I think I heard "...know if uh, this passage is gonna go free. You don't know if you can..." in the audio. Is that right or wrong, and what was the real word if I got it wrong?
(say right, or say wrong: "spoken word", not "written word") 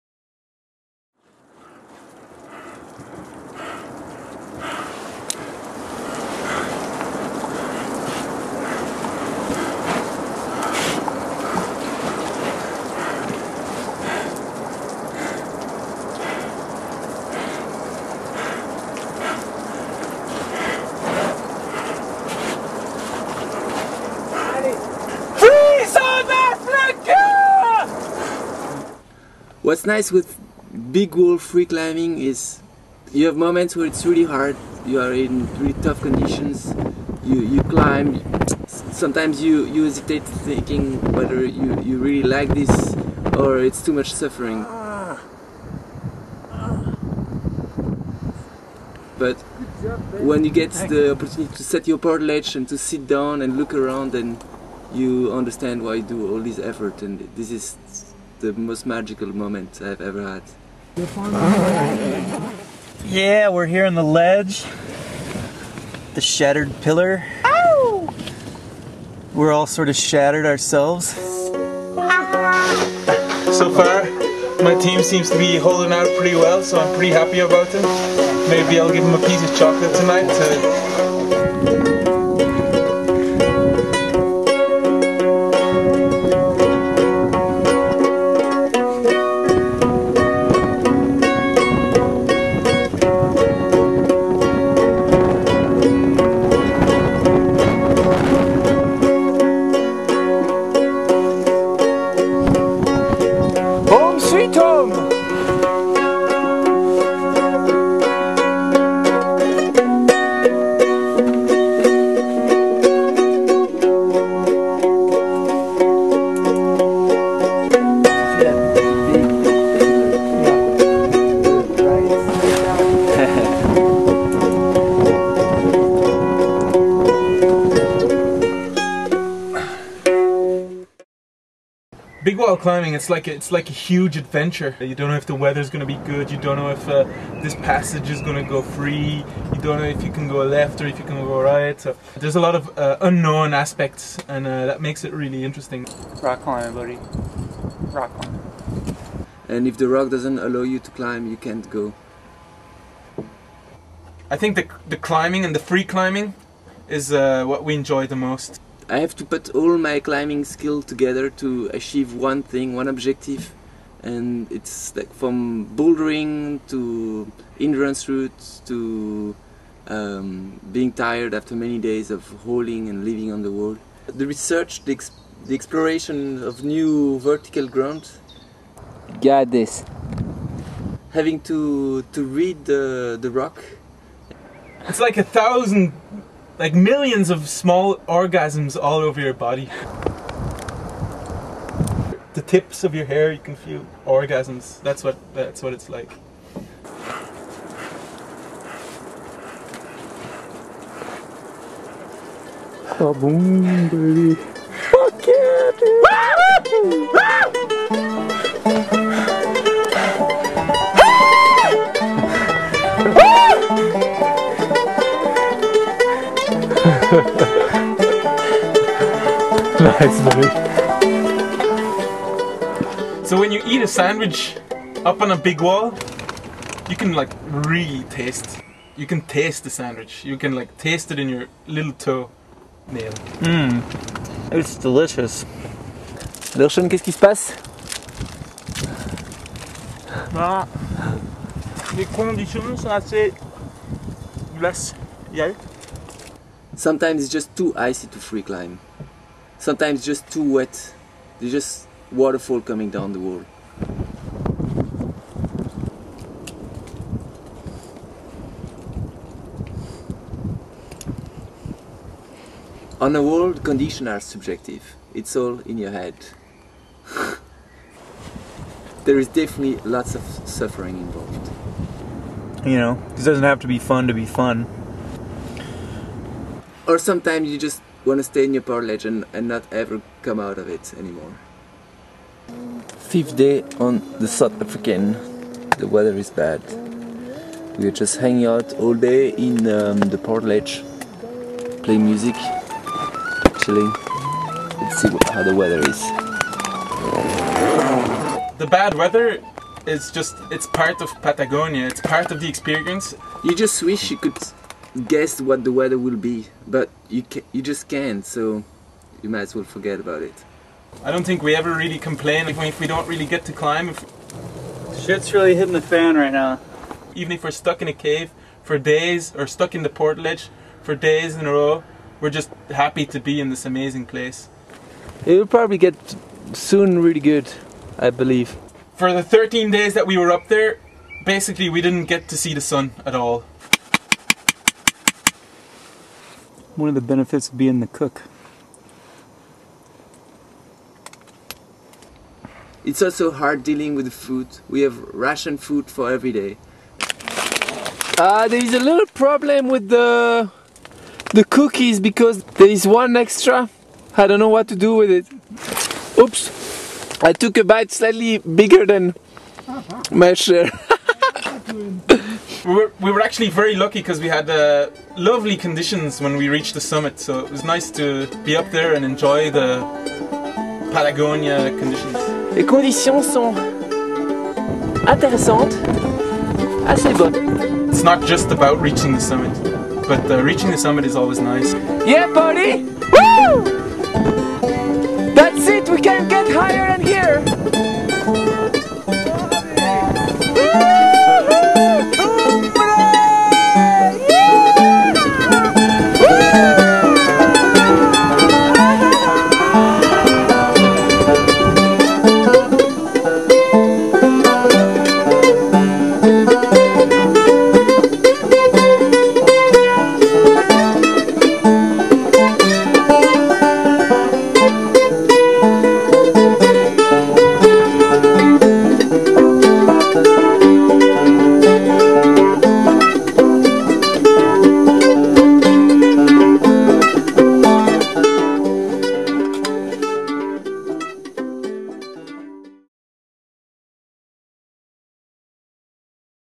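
right.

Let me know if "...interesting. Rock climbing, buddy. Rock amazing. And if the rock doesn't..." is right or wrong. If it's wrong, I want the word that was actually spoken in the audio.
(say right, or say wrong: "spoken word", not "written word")
wrong: "climbing", not "amazing".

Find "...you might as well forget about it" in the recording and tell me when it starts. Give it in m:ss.
5:09.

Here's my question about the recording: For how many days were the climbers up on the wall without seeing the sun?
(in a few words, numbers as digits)
13.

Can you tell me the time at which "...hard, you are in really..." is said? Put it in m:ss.
0:34.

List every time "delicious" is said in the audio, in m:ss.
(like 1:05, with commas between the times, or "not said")
3:54.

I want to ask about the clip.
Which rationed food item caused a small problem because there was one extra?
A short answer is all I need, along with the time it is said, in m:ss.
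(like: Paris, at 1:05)
Cookies, at 5:51.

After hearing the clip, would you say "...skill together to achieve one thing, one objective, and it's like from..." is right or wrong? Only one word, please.
right.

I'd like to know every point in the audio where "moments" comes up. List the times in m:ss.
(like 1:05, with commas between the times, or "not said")
0:33, 0:59.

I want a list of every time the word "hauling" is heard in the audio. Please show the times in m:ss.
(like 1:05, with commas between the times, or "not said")
2:52.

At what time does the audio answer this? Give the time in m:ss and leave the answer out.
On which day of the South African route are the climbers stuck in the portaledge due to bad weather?
4:43.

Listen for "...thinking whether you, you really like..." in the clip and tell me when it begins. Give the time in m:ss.
0:40.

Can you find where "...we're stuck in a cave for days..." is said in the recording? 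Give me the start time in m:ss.
5:17.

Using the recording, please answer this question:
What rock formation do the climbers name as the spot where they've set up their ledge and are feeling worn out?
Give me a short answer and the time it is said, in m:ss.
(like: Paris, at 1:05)
The Shattered Pillar, at 1:06.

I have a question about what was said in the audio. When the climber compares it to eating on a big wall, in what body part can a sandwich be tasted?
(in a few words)
Little toe nail.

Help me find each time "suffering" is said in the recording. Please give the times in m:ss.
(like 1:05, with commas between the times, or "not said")
0:44, 4:30.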